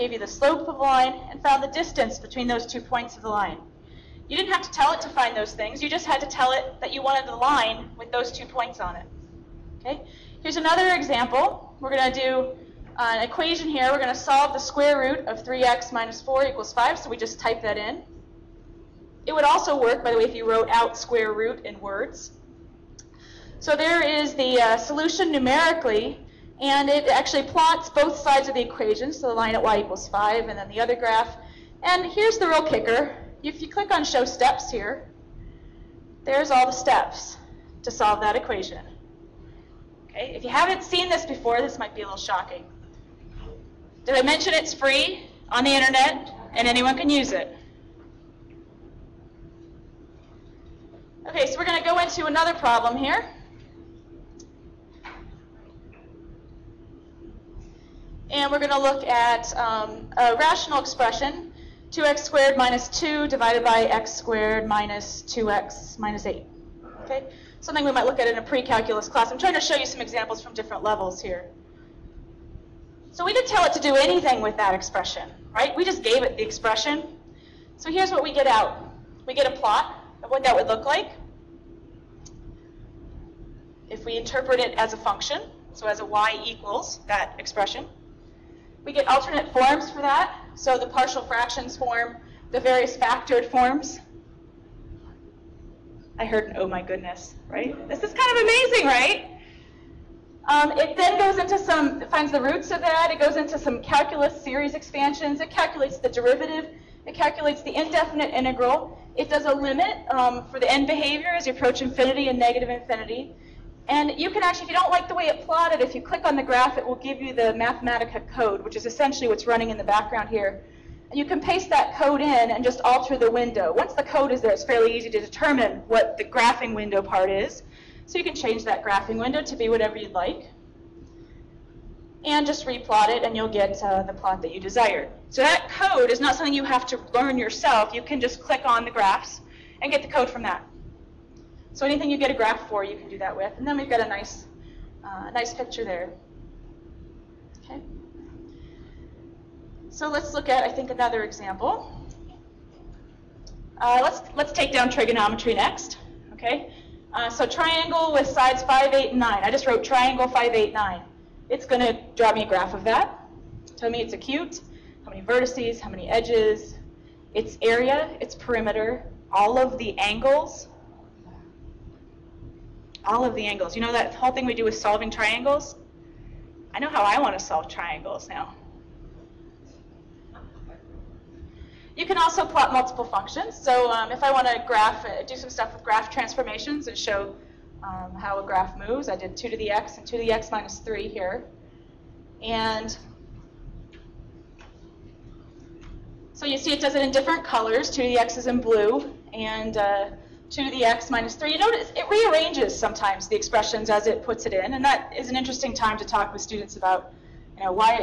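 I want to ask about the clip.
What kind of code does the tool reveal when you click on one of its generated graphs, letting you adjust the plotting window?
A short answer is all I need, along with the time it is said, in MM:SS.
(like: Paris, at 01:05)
Mathematica, at 01:57.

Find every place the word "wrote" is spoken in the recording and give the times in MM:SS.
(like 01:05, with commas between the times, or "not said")
00:20, 02:39.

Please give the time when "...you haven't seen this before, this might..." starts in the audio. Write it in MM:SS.
00:40.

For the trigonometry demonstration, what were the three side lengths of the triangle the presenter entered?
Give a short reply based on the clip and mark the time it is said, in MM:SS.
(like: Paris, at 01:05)
5, 8, and 9, at 02:38.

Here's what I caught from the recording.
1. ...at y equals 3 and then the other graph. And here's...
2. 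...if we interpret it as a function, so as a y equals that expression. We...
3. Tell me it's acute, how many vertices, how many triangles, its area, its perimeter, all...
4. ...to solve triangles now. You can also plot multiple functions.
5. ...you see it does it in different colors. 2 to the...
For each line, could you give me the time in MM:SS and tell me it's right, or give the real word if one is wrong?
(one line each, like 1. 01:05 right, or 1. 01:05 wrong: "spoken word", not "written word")
1. 00:29 wrong: "5", not "3"
2. 01:23 right
3. 02:43 wrong: "edges", not "triangles"
4. 02:57 right
5. 03:16 right.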